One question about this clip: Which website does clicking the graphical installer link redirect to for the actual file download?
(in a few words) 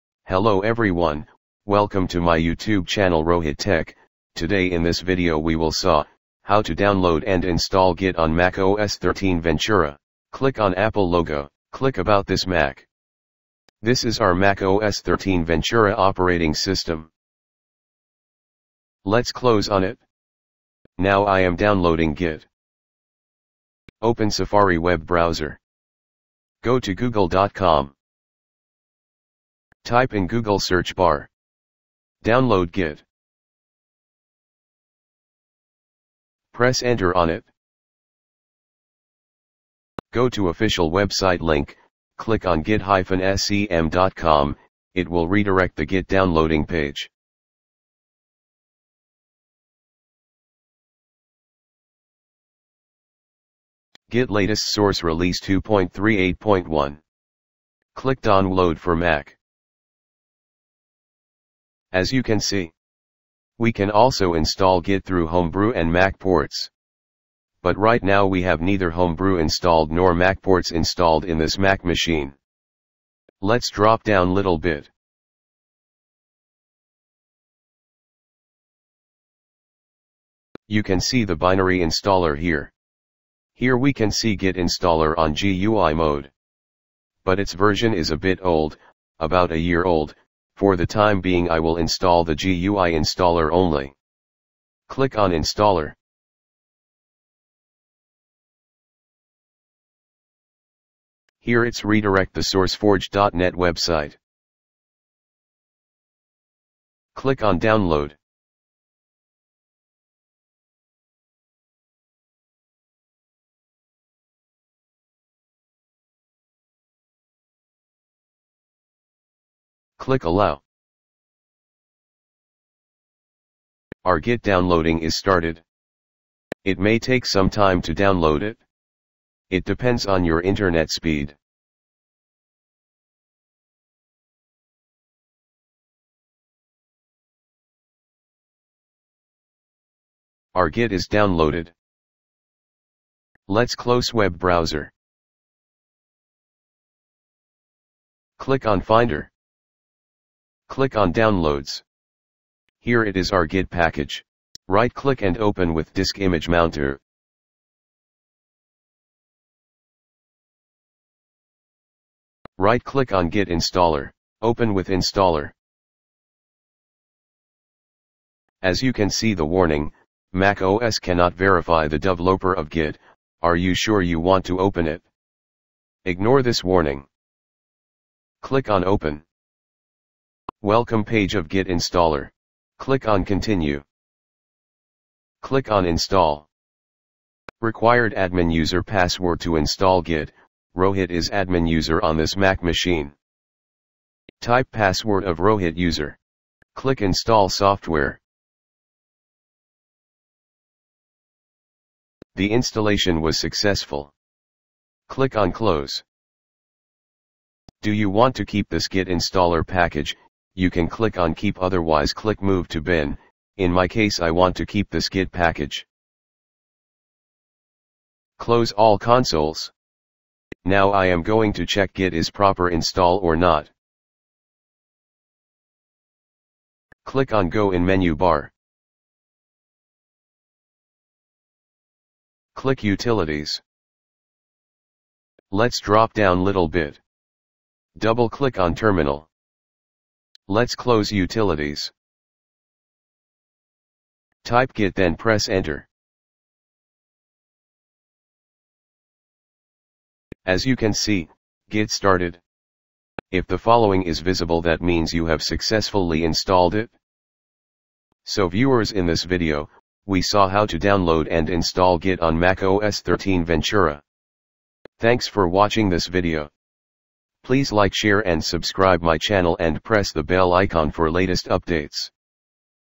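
sourceforge.net.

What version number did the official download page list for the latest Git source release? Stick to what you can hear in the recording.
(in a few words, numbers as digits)
2.38.1.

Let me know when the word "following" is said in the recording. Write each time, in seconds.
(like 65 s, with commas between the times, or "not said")
253 s.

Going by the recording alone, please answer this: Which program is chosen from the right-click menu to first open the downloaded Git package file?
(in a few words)
Disk Image Mounter.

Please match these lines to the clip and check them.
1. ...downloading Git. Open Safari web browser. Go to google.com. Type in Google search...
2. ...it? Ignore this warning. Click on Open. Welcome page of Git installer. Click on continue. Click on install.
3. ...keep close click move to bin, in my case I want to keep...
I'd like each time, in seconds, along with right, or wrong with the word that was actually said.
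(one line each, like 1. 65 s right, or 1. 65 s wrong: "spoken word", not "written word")
1. 21 s right
2. 174 s right
3. 211 s wrong: "otherwise", not "close".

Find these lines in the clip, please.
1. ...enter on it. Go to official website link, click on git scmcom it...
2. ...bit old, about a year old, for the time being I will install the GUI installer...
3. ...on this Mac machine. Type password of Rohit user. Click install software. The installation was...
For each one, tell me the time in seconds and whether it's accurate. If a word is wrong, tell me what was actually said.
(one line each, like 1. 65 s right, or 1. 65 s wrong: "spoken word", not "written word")
1. 36 s right
2. 88 s right
3. 192 s right.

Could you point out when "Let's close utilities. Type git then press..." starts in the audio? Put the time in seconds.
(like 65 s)
240 s.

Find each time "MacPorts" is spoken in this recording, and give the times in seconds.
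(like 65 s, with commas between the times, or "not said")
65 s, 70 s.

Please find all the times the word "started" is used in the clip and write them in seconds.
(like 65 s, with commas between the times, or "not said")
125 s, 251 s.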